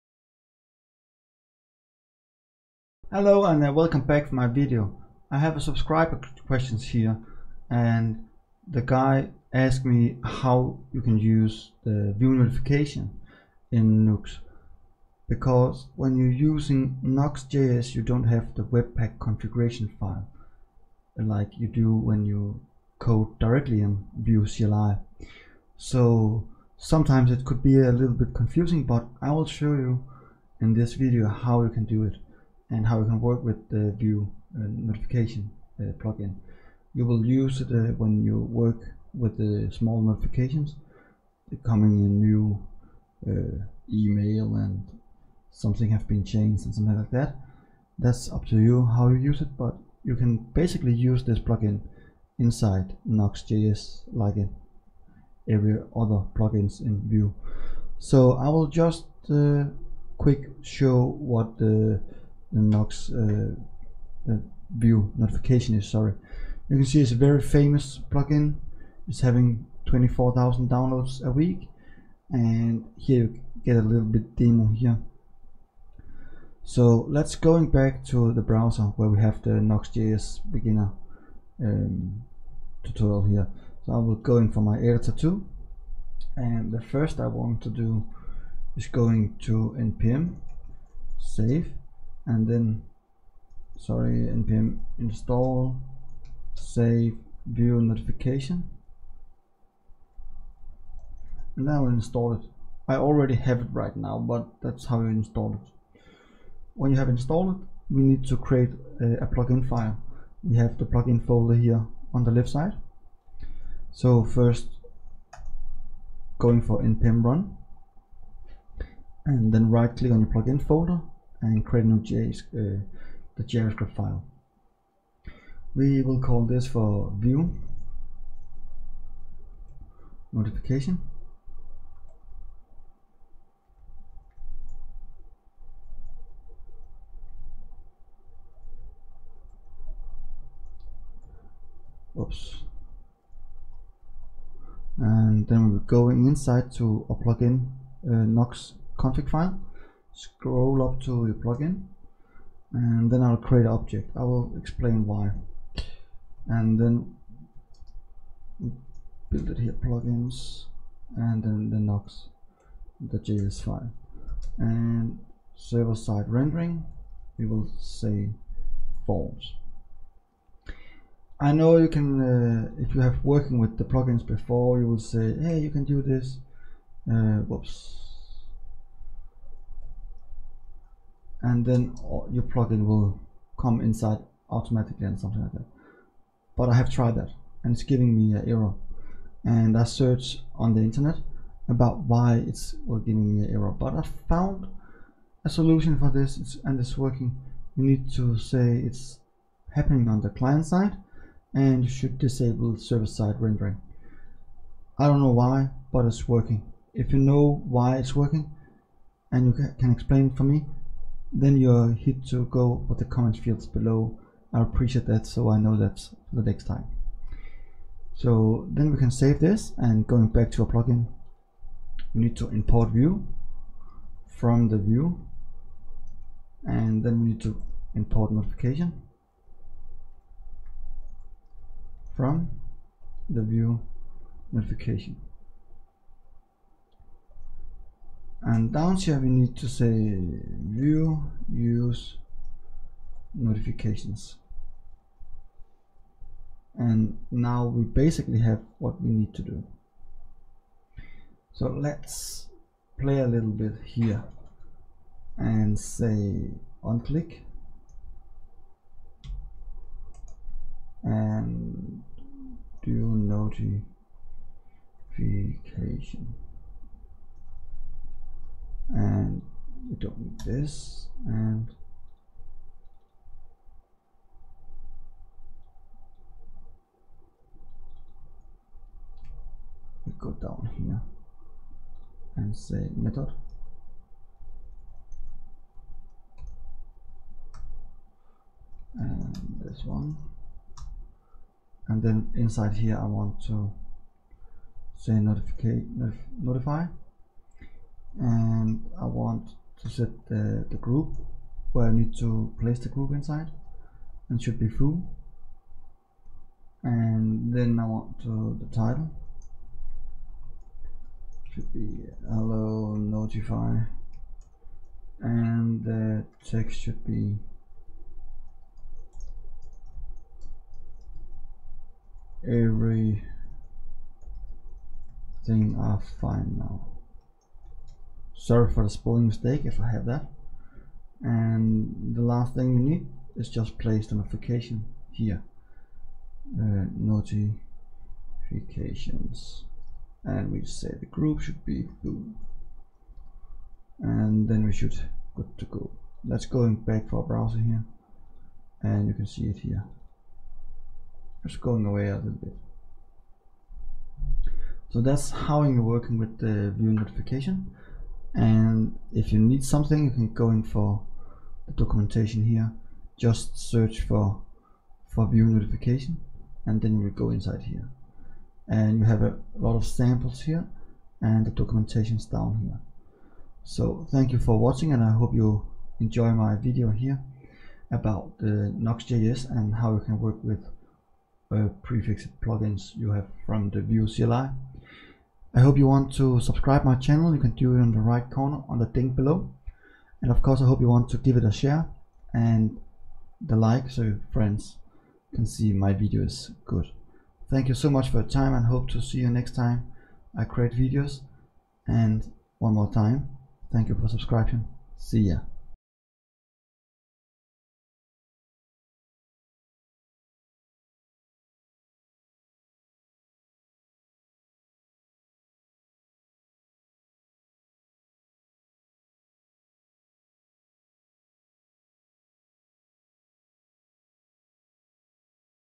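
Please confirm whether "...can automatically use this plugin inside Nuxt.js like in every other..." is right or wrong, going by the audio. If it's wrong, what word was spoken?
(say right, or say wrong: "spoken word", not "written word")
wrong: "basically", not "automatically".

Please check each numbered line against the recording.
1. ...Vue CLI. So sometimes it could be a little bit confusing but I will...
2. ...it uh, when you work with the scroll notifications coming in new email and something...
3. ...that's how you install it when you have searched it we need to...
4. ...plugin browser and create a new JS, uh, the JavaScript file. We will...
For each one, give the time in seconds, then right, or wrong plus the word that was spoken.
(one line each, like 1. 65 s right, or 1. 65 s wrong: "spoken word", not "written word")
1. 24 s right
2. 37 s wrong: "small", not "scroll"
3. 104 s wrong: "installed", not "searched"
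4. 120 s wrong: "folder", not "browser".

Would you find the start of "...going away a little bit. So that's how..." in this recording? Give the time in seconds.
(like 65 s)
351 s.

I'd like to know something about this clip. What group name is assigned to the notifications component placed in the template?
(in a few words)
blue.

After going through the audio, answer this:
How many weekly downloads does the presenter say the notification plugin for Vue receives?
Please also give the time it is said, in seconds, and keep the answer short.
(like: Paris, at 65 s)
24,000, at 69 s.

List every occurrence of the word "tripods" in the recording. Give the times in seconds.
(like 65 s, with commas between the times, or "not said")
not said.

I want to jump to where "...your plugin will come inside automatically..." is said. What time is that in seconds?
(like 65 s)
182 s.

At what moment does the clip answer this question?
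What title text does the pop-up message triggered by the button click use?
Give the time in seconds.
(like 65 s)
312 s.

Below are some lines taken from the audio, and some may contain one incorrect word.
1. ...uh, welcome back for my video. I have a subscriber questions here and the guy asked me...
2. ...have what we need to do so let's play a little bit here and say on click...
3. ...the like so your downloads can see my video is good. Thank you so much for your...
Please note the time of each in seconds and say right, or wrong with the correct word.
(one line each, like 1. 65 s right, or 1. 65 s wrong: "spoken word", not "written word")
1. 3 s right
2. 248 s right
3. 393 s wrong: "friends", not "downloads".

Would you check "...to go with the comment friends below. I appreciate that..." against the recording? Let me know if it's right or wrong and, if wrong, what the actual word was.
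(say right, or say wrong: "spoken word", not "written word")
wrong: "fields", not "friends".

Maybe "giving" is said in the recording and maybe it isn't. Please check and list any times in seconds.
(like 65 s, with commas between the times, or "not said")
187 s, 193 s.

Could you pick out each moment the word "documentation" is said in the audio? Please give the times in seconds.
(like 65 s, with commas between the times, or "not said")
361 s, 371 s.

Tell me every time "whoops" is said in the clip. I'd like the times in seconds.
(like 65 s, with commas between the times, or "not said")
177 s.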